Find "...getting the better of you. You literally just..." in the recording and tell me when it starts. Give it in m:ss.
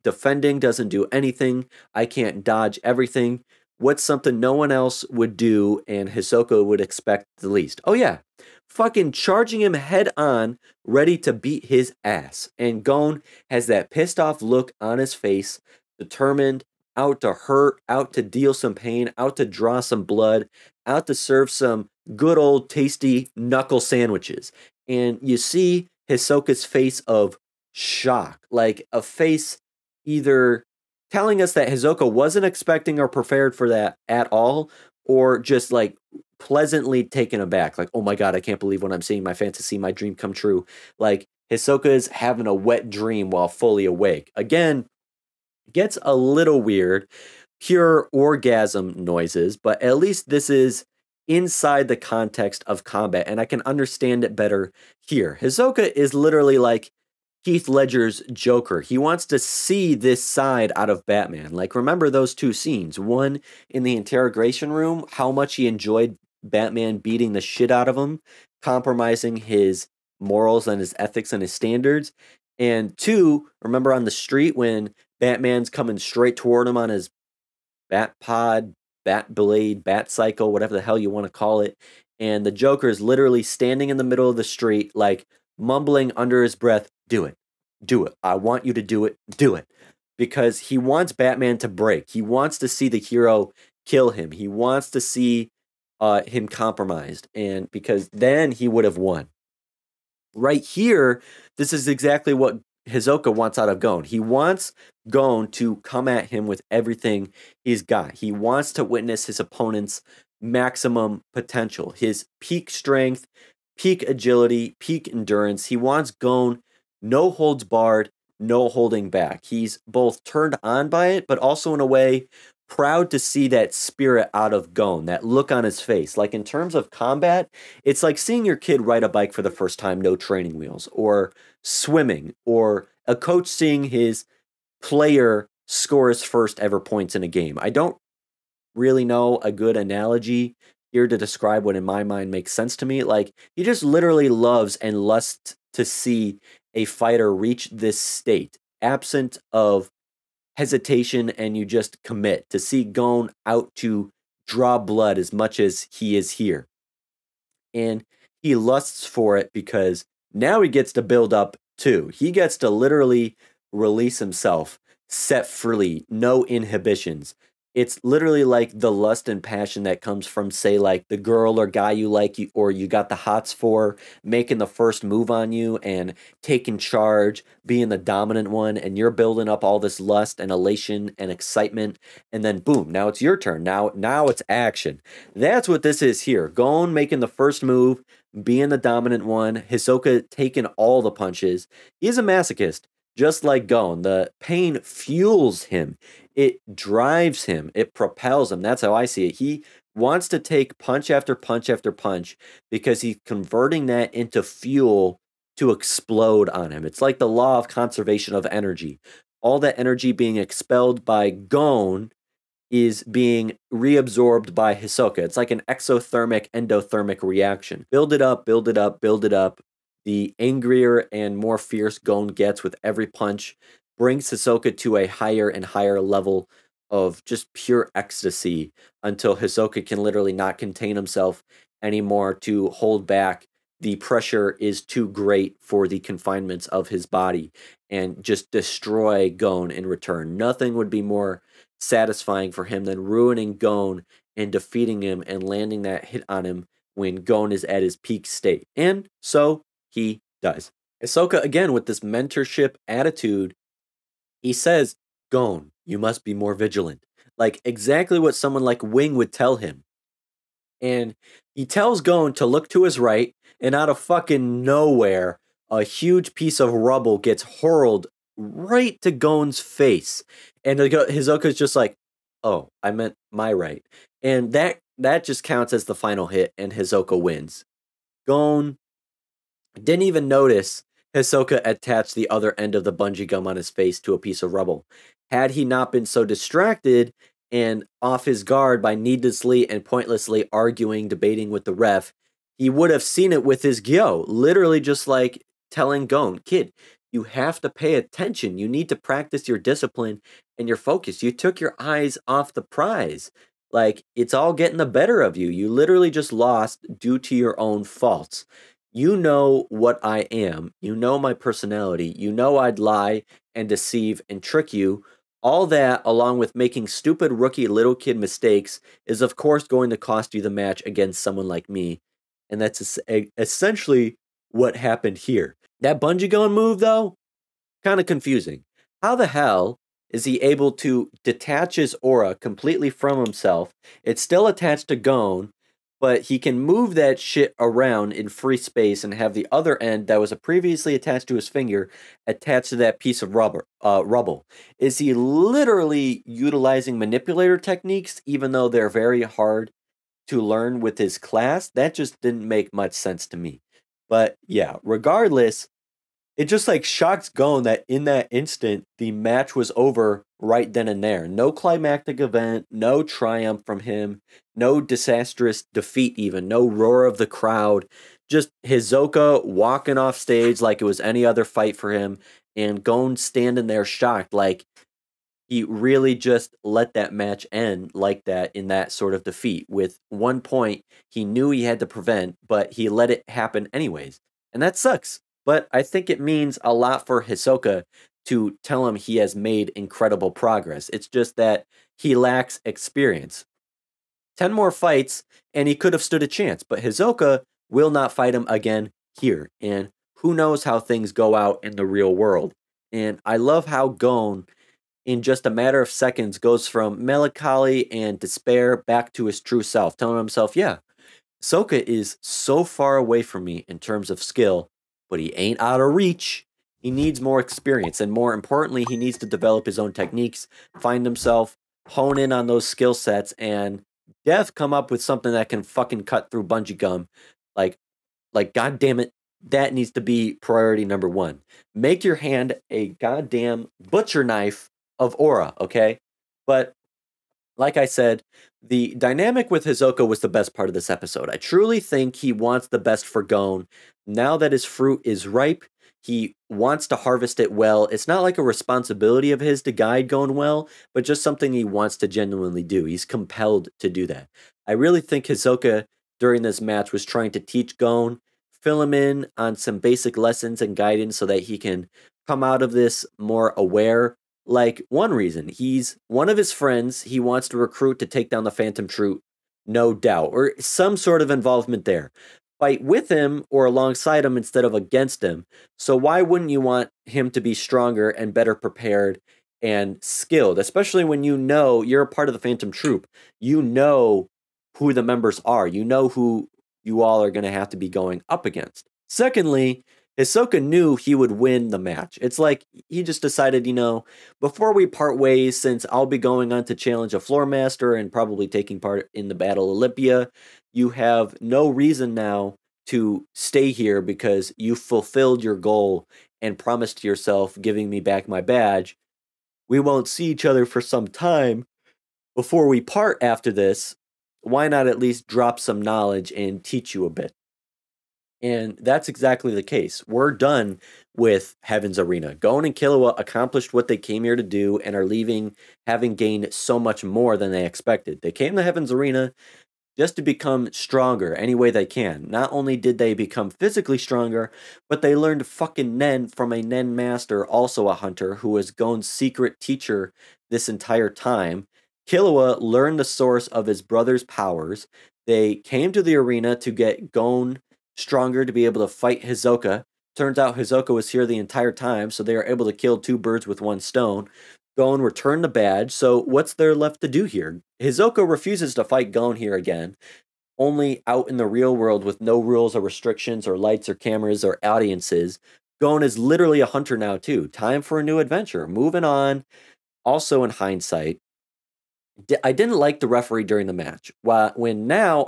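5:04.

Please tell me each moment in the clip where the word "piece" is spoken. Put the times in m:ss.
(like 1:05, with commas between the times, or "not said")
4:26, 4:44, 5:42.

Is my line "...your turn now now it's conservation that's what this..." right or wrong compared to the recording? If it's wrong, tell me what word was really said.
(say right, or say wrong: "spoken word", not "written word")
wrong: "action", not "conservation".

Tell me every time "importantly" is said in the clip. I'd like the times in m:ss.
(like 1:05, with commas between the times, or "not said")
6:58.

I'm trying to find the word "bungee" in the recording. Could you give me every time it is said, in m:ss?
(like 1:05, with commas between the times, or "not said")
4:42, 5:26, 7:06.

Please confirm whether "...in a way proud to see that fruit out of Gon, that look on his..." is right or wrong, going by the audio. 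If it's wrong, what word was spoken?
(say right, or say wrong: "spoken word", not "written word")
wrong: "spirit", not "fruit".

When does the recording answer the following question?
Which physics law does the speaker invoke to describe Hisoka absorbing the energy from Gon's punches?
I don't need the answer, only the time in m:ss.
3:27.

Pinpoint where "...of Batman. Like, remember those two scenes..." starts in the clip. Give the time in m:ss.
1:00.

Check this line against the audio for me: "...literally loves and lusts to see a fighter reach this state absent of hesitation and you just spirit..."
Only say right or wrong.
wrong.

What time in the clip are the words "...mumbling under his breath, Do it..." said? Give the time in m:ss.
1:25.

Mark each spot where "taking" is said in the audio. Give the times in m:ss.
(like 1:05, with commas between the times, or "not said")
2:56, 3:10, 8:18.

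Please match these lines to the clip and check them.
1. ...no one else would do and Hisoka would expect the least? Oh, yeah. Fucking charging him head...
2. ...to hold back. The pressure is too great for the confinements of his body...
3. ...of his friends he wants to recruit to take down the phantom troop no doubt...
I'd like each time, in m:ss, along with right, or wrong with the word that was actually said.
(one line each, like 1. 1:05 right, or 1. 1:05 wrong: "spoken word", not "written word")
1. 0:04 right
2. 3:52 right
3. 7:46 right.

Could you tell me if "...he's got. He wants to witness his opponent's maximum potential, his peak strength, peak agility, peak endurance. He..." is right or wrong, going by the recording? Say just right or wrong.
right.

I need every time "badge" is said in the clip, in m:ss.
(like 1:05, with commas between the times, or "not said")
8:28, 9:15.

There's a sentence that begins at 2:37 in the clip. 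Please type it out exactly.
And he lusts for it because now he gets to build up too.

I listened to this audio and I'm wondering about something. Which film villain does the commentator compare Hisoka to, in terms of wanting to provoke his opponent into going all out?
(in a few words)
Heath Ledger's Joker.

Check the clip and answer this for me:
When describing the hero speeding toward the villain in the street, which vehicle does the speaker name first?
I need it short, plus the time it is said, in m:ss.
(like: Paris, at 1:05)
bat pod, at 1:17.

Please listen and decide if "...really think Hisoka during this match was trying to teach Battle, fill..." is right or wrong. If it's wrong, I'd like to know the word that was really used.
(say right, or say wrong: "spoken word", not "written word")
wrong: "Gon", not "Battle".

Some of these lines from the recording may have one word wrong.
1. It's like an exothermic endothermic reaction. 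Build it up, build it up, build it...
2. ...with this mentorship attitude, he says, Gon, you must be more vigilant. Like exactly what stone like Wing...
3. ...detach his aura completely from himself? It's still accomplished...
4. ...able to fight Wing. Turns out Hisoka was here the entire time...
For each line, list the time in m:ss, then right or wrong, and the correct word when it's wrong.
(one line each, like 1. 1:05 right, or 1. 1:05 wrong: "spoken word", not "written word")
1. 3:35 right
2. 4:11 wrong: "someone", not "stone"
3. 5:31 wrong: "attached", not "accomplished"
4. 9:08 wrong: "Hisoka", not "Wing".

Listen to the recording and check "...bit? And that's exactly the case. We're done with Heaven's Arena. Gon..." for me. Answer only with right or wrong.
right.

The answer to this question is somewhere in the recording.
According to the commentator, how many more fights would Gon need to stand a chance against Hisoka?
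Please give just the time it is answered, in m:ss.
6:34.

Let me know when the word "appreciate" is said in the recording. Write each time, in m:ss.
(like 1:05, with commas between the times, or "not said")
not said.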